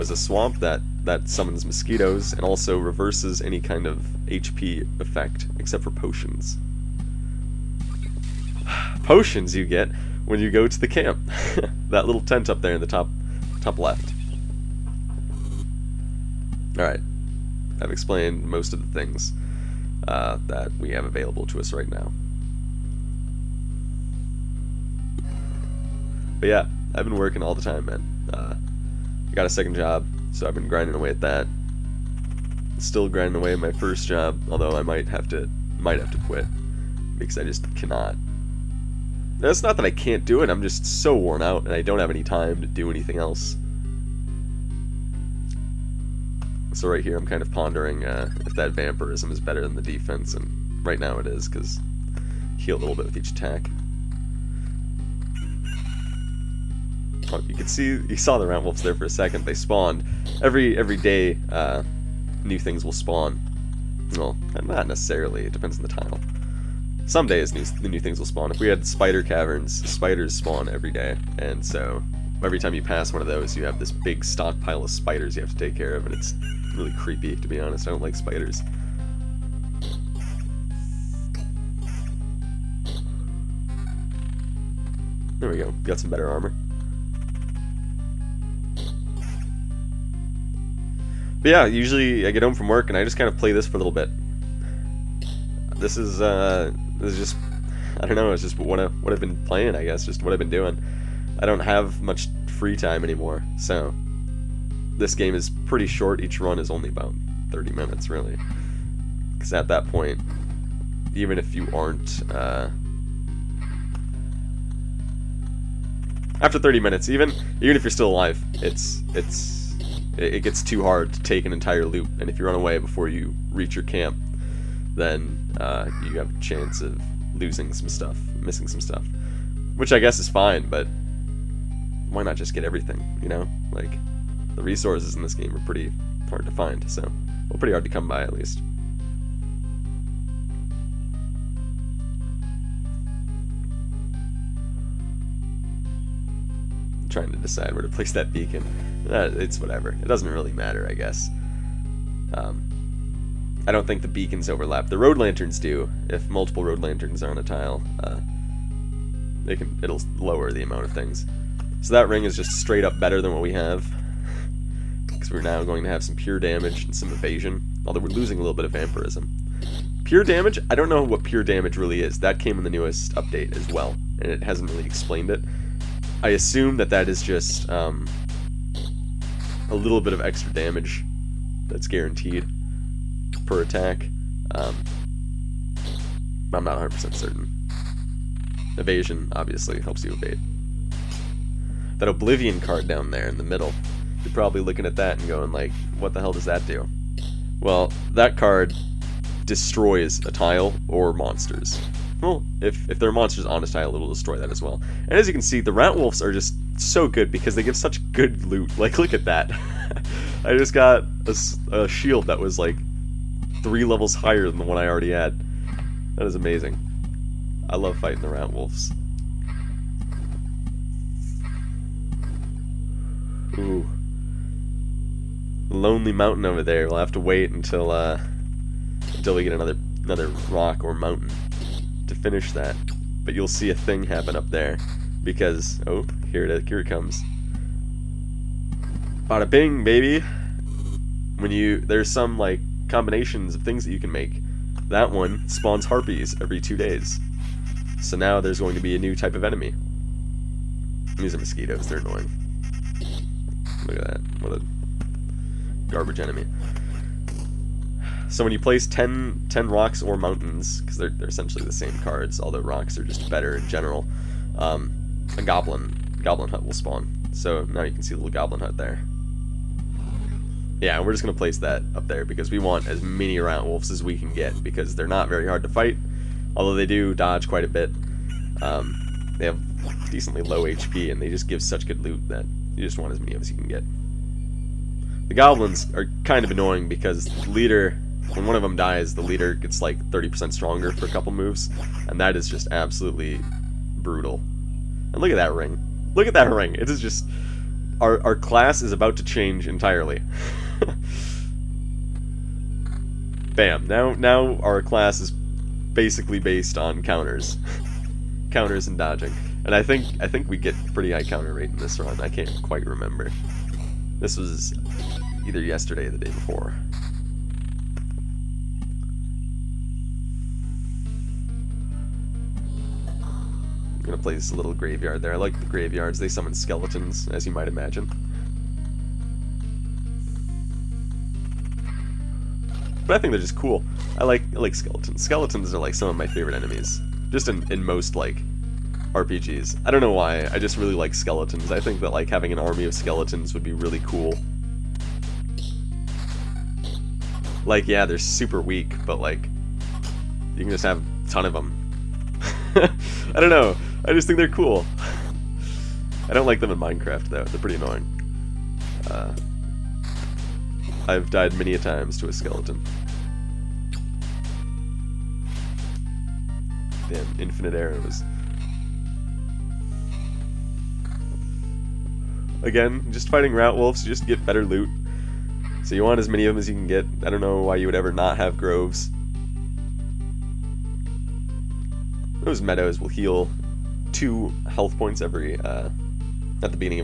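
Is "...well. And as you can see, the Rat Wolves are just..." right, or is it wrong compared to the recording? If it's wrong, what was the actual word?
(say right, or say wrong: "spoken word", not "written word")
right.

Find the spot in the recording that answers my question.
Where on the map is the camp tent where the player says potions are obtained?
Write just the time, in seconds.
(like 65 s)
12 s.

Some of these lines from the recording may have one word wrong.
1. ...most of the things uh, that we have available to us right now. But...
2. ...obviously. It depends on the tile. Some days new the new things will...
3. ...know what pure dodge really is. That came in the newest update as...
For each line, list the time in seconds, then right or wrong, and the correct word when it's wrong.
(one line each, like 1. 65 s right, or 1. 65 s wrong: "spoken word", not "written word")
1. 18 s right
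2. 64 s wrong: "necessarily", not "obviously"
3. 170 s wrong: "damage", not "dodge".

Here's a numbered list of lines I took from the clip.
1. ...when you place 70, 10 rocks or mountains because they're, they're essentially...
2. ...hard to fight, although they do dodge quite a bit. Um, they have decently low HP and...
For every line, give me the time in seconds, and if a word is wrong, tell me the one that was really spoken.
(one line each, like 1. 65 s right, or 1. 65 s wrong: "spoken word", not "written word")
1. 258 s wrong: "10", not "70"
2. 275 s right.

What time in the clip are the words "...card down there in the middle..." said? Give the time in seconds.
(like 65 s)
192 s.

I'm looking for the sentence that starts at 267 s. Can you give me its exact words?
So now you can see the little goblin hut there.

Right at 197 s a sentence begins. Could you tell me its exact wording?
Well, that card destroys a tile or monsters.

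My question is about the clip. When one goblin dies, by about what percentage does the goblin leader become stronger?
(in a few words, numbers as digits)
30%.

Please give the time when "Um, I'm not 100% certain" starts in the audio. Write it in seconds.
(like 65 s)
184 s.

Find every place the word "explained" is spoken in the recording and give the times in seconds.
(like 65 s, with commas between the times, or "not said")
17 s, 174 s.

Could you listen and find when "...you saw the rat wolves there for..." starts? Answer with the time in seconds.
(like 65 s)
58 s.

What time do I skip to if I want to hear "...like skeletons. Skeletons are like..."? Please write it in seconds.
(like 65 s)
334 s.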